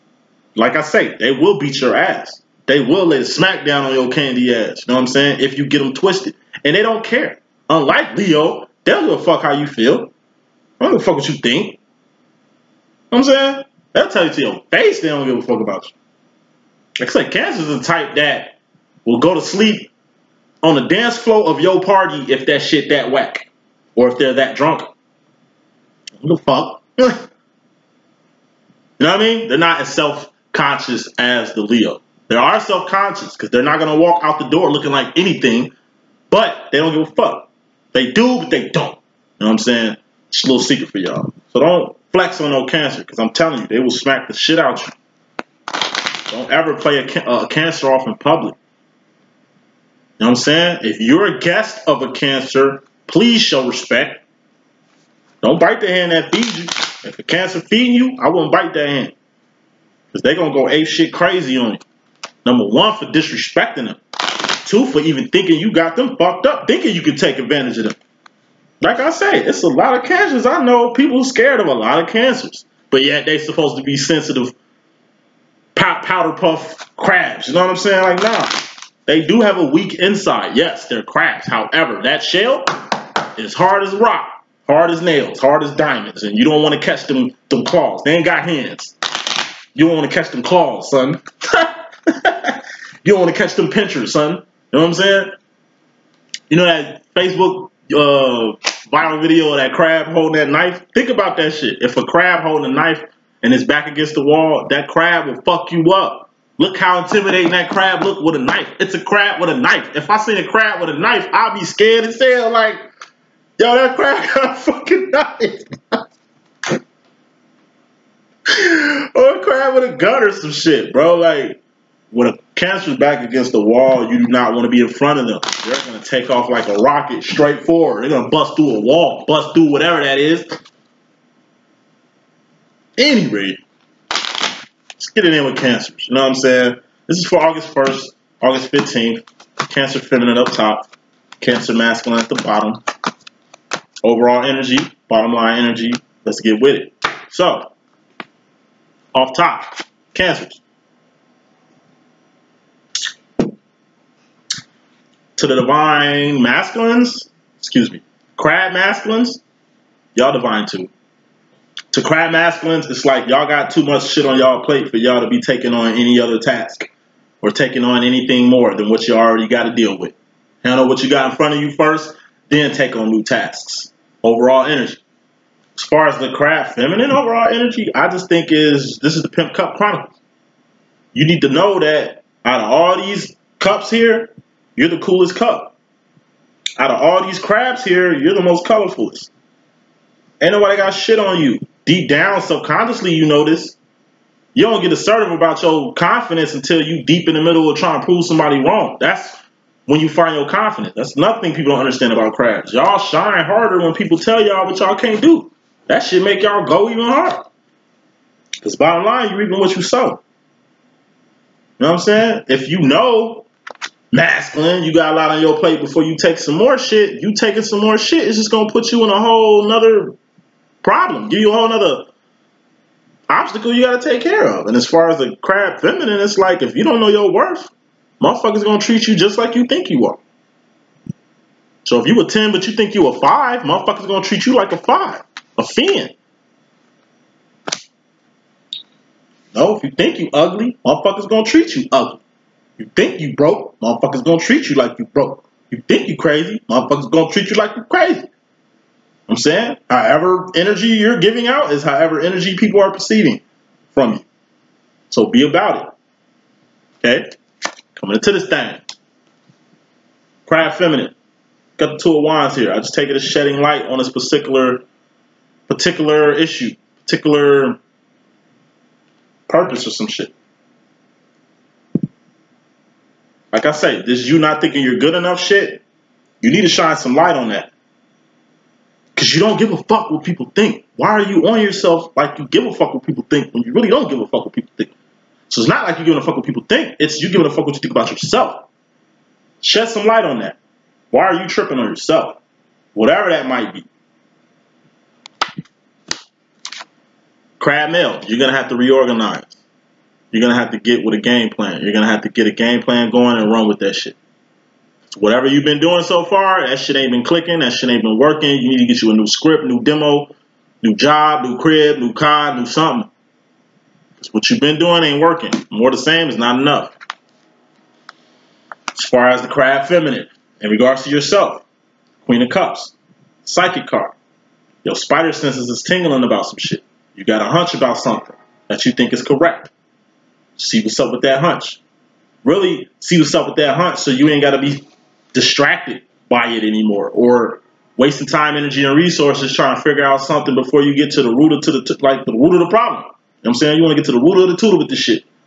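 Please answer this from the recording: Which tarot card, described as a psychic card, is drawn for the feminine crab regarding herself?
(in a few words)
Queen of Cups.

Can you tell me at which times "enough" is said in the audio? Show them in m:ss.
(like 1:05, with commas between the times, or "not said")
4:35, 5:16.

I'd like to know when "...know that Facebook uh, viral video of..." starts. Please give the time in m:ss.
1:36.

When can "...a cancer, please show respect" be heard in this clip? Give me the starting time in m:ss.
0:52.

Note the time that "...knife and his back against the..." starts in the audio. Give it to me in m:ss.
1:42.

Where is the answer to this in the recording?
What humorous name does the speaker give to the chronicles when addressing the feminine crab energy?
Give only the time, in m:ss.
2:59.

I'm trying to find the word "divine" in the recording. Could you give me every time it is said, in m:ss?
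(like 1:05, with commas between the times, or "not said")
2:35, 2:40.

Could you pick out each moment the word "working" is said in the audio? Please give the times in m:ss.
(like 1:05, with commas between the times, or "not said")
5:08, 5:15.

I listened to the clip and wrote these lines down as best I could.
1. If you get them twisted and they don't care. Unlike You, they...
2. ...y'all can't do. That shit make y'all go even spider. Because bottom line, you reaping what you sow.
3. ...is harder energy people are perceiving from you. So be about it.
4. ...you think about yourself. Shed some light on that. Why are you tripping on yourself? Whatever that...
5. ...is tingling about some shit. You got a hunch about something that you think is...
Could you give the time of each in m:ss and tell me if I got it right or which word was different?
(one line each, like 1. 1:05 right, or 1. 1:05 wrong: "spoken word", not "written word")
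1. 0:05 wrong: "Leo", not "You"
2. 3:24 wrong: "harder", not "spider"
3. 4:11 wrong: "however", not "harder"
4. 4:47 right
5. 5:25 right.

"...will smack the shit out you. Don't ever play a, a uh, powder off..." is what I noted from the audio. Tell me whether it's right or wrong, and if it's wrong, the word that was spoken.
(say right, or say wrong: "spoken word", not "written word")
wrong: "cancer", not "powder".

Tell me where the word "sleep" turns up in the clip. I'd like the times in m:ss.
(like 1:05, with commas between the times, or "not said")
0:19.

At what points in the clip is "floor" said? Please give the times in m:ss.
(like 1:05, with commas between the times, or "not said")
0:21.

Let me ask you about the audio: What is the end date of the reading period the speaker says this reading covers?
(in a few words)
August 15th.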